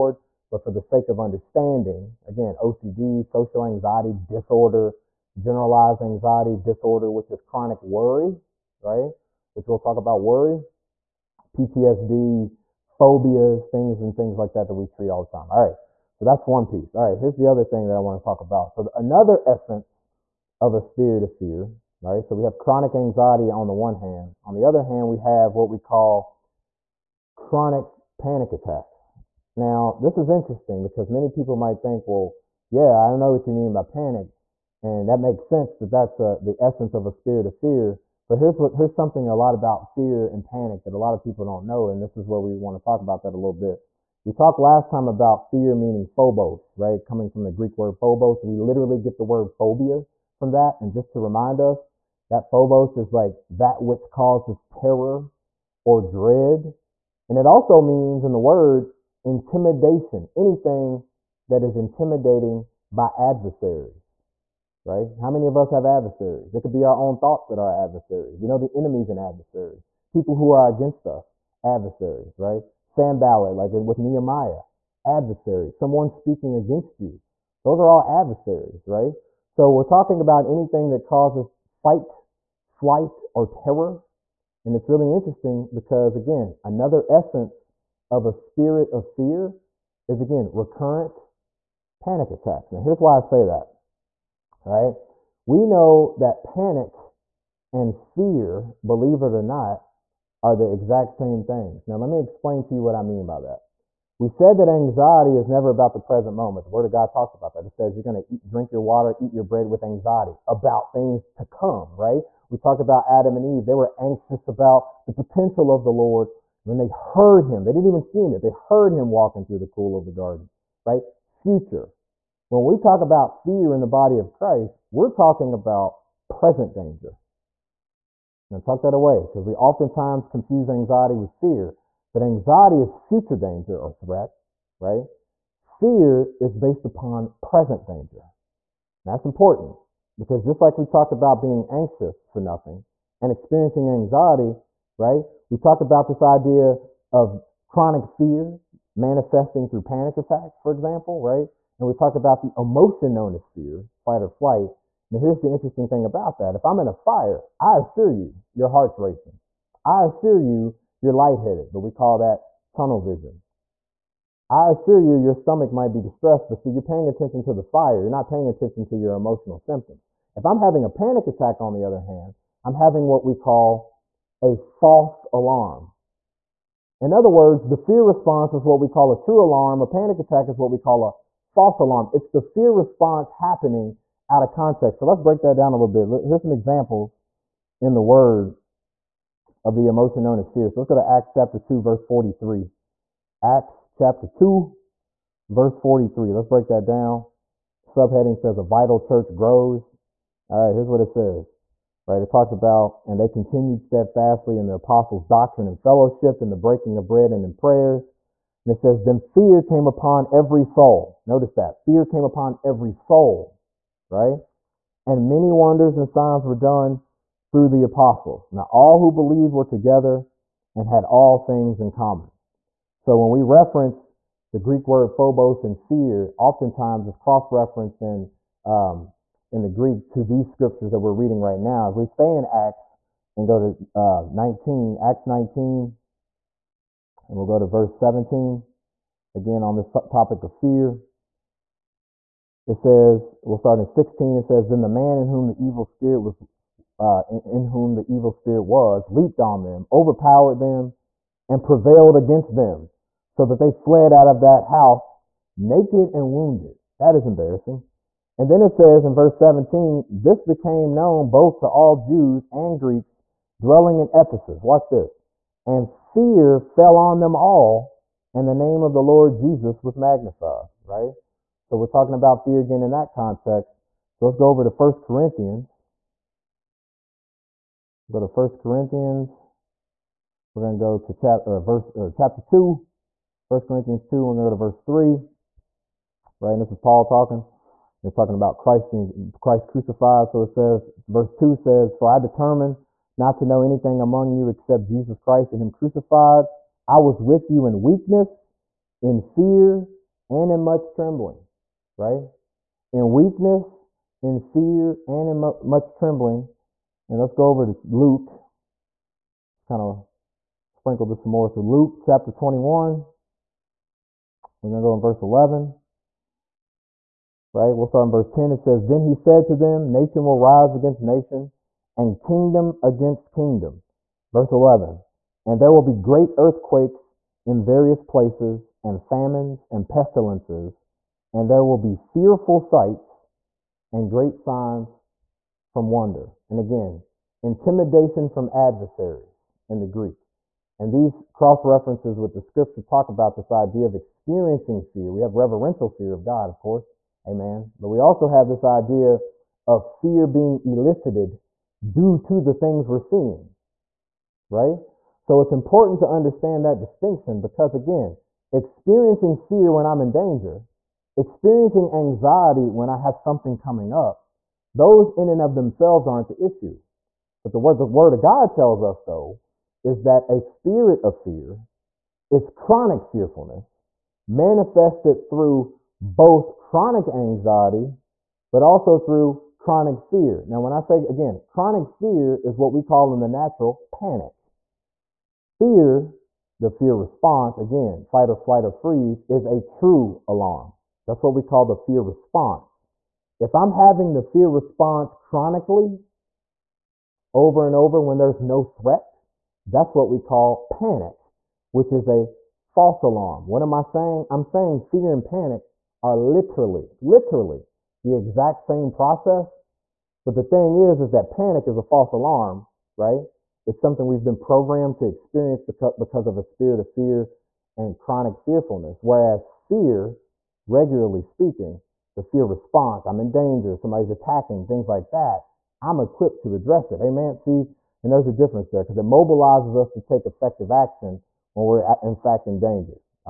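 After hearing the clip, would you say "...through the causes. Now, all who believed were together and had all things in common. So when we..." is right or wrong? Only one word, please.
wrong.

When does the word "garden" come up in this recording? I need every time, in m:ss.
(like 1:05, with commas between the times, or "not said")
2:00.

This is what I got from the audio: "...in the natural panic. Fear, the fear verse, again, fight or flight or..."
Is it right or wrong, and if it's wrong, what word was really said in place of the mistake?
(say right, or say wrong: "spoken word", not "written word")
wrong: "response", not "verse".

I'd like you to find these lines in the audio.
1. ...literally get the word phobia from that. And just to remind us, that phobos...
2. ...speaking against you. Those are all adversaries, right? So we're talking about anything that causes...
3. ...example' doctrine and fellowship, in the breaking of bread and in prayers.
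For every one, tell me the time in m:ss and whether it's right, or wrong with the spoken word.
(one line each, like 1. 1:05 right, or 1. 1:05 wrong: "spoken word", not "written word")
1. 0:48 right
2. 1:16 right
3. 3:24 wrong: "apostles", not "example".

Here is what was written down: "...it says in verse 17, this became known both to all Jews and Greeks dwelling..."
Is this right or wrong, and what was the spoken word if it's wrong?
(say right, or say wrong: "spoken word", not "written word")
right.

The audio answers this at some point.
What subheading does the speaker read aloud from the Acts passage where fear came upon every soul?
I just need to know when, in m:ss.
3:18.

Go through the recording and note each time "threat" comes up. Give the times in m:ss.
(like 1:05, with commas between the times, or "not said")
2:13, 6:38.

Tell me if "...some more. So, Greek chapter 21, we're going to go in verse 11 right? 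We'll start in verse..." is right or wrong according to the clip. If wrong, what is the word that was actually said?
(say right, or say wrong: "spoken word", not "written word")
wrong: "Luke", not "Greek".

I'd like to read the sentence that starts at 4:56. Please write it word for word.
I was with you in weakness, in fear, and in much trembling, right?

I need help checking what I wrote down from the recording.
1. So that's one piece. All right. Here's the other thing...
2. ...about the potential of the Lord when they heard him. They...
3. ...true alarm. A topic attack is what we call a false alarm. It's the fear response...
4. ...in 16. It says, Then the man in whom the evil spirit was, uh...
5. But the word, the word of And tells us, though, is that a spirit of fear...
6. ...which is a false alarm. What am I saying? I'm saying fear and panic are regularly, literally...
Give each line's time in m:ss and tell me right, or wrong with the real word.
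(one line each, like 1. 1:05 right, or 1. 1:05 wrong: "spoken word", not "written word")
1. 0:16 right
2. 1:54 right
3. 2:59 wrong: "panic", not "topic"
4. 4:03 right
5. 6:07 wrong: "God", not "And"
6. 6:41 wrong: "literally", not "regularly".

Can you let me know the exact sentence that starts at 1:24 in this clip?
And it's really interesting because, again, another essence of a spirit of fear is, again, recurrent panic attacks.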